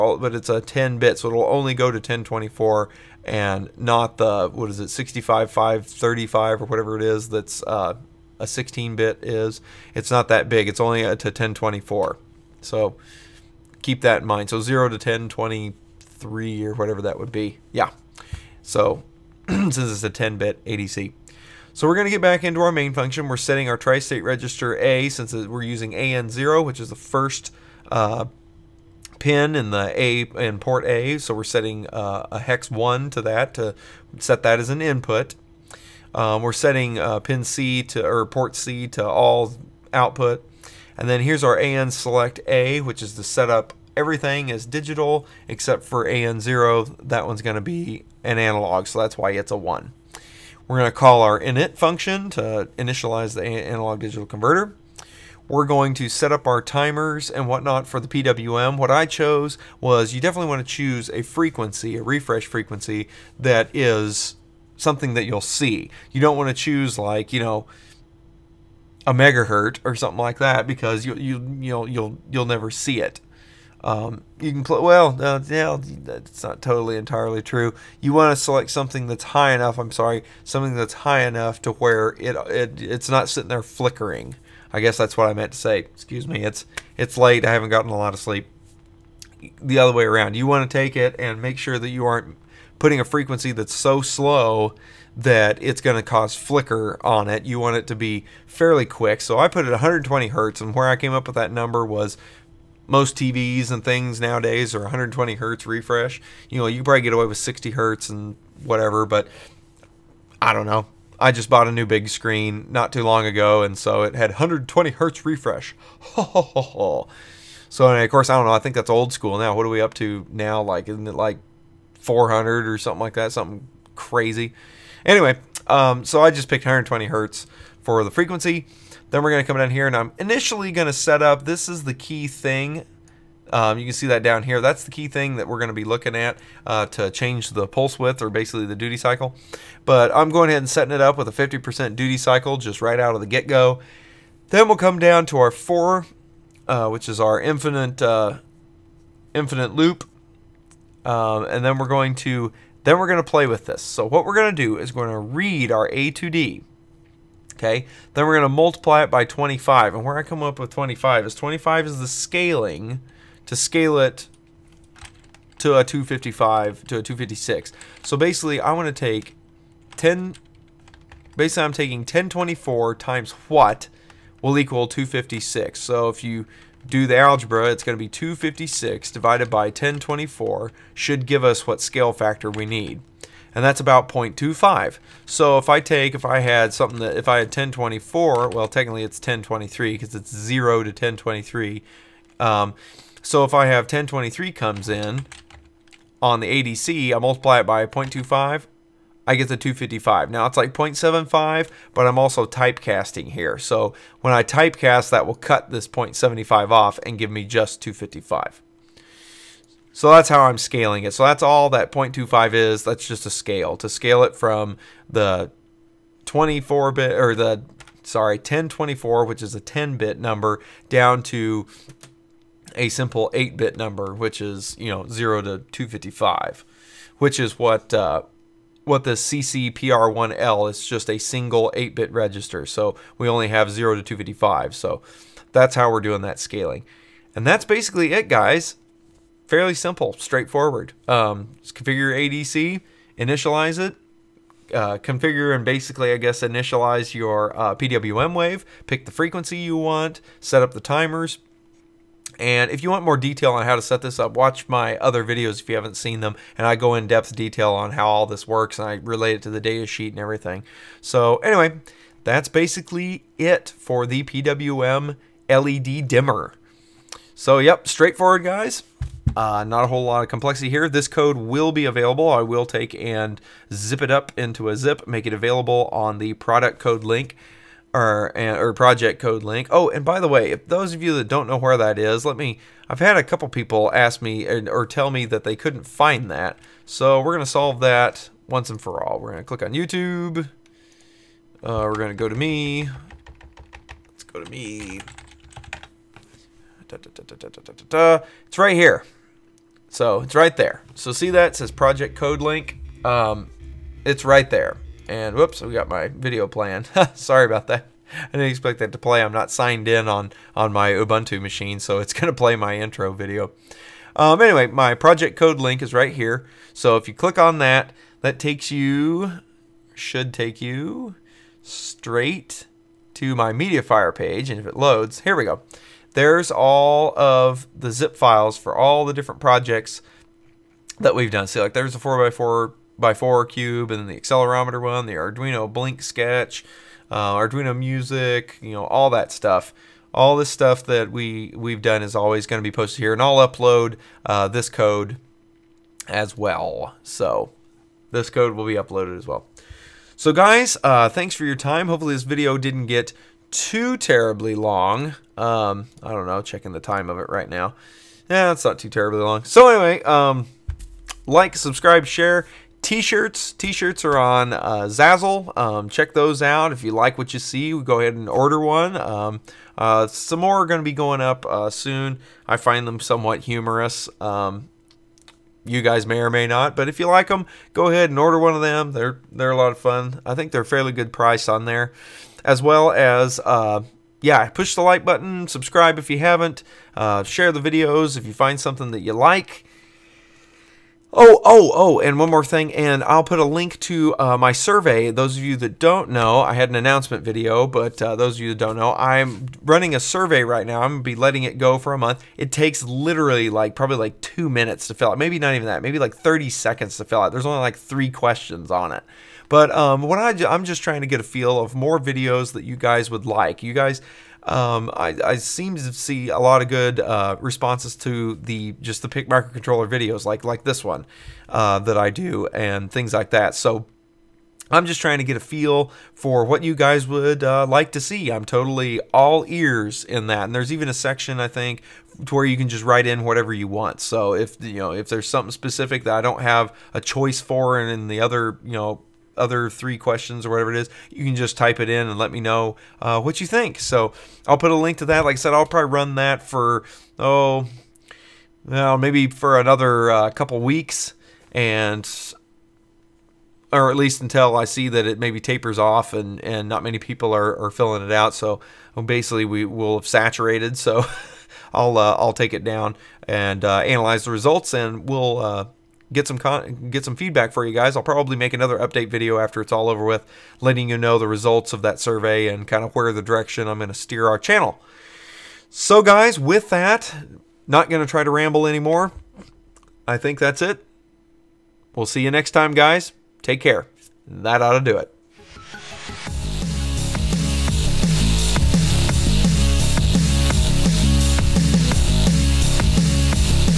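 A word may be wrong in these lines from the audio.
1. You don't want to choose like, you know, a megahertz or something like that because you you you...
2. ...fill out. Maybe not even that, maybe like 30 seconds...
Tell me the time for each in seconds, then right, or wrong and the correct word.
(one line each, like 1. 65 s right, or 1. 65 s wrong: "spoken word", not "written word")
1. 66 s right
2. 404 s right.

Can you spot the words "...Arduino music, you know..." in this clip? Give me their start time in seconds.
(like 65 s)
337 s.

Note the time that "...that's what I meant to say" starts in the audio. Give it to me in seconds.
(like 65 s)
84 s.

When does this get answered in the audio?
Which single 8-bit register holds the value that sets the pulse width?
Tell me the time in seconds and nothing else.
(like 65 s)
229 s.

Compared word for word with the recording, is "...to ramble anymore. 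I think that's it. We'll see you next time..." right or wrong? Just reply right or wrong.
right.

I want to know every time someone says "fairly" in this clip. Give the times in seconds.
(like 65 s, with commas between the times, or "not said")
98 s, 239 s, 380 s.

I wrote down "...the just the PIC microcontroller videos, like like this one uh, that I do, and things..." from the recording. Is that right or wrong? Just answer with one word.
right.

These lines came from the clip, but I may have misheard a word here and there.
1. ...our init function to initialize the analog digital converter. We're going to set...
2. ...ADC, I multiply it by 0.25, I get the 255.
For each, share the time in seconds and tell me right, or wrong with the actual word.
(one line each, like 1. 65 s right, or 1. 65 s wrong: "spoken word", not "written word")
1. 51 s right
2. 196 s right.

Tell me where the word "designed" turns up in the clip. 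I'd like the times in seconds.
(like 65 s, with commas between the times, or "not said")
not said.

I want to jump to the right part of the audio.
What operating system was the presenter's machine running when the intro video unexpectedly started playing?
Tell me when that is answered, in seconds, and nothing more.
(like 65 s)
310 s.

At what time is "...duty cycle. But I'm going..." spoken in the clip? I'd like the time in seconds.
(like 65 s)
138 s.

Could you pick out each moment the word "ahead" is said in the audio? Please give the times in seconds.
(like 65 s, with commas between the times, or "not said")
140 s, 367 s, 377 s.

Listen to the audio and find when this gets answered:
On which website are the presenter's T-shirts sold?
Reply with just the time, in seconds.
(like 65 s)
364 s.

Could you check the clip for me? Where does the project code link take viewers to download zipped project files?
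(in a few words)
MediaFire.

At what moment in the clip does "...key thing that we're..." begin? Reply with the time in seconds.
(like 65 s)
134 s.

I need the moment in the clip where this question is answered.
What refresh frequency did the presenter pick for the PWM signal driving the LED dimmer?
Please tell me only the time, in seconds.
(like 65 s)
99 s.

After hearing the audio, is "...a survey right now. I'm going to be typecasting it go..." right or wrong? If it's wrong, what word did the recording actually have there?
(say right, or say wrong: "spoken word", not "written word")
wrong: "letting", not "typecasting".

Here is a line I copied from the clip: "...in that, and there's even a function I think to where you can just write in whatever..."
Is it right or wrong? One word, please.
wrong.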